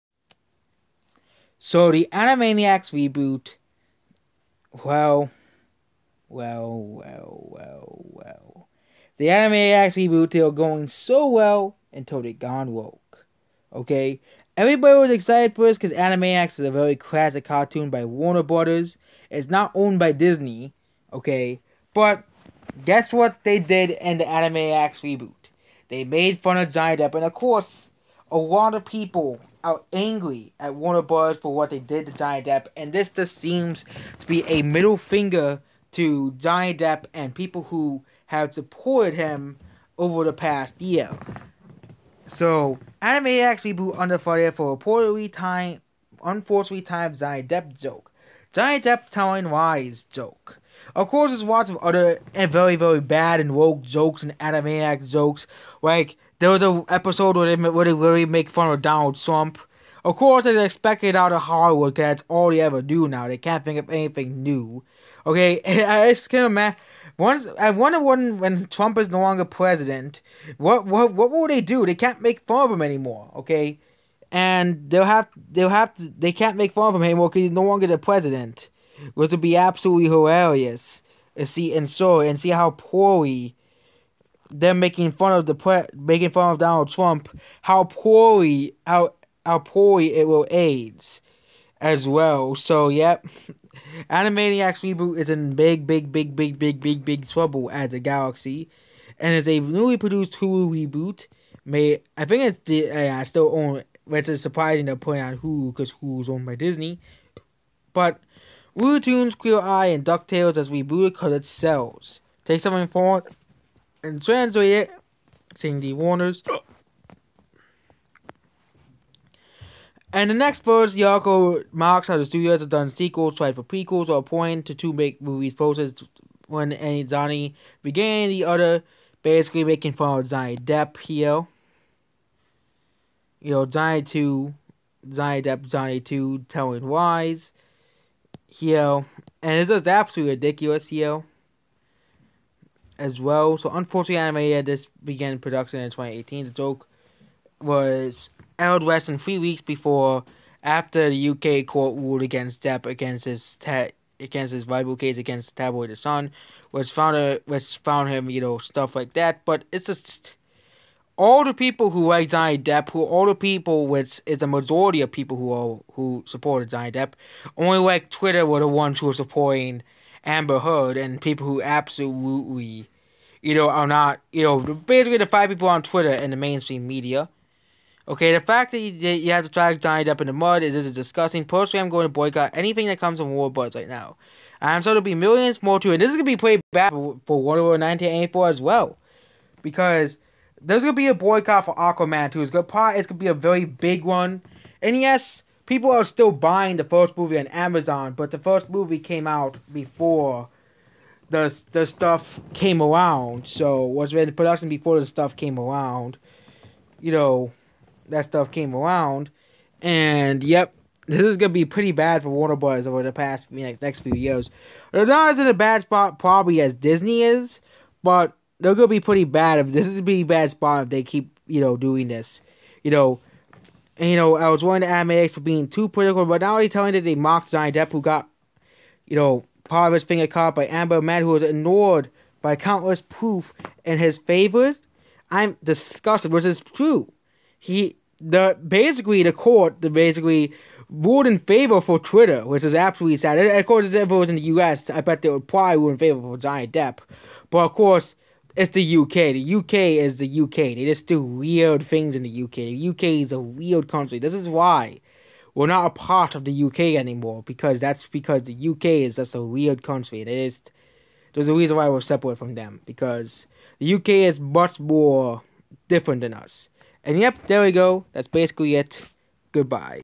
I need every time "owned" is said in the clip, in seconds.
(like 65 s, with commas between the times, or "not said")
19 s, 106 s.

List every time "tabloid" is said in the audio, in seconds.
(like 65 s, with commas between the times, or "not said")
155 s.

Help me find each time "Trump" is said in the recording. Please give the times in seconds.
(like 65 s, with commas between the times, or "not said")
59 s, 68 s, 86 s.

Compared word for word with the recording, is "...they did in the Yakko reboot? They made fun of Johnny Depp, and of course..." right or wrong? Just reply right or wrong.
wrong.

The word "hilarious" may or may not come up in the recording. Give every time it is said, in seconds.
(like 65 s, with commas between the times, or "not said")
80 s.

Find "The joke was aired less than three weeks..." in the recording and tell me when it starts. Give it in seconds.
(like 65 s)
146 s.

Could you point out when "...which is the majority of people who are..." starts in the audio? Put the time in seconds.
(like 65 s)
163 s.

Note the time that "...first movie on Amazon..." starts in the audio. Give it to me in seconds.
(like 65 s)
196 s.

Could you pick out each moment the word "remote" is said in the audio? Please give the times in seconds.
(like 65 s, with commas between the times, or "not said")
not said.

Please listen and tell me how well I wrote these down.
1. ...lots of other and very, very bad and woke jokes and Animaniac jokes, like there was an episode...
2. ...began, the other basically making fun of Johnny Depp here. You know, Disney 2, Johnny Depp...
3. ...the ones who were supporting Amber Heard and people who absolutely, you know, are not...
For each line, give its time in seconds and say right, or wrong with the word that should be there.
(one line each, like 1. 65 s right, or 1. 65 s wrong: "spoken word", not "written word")
1. 51 s right
2. 127 s wrong: "Johnny", not "Disney"
3. 168 s right.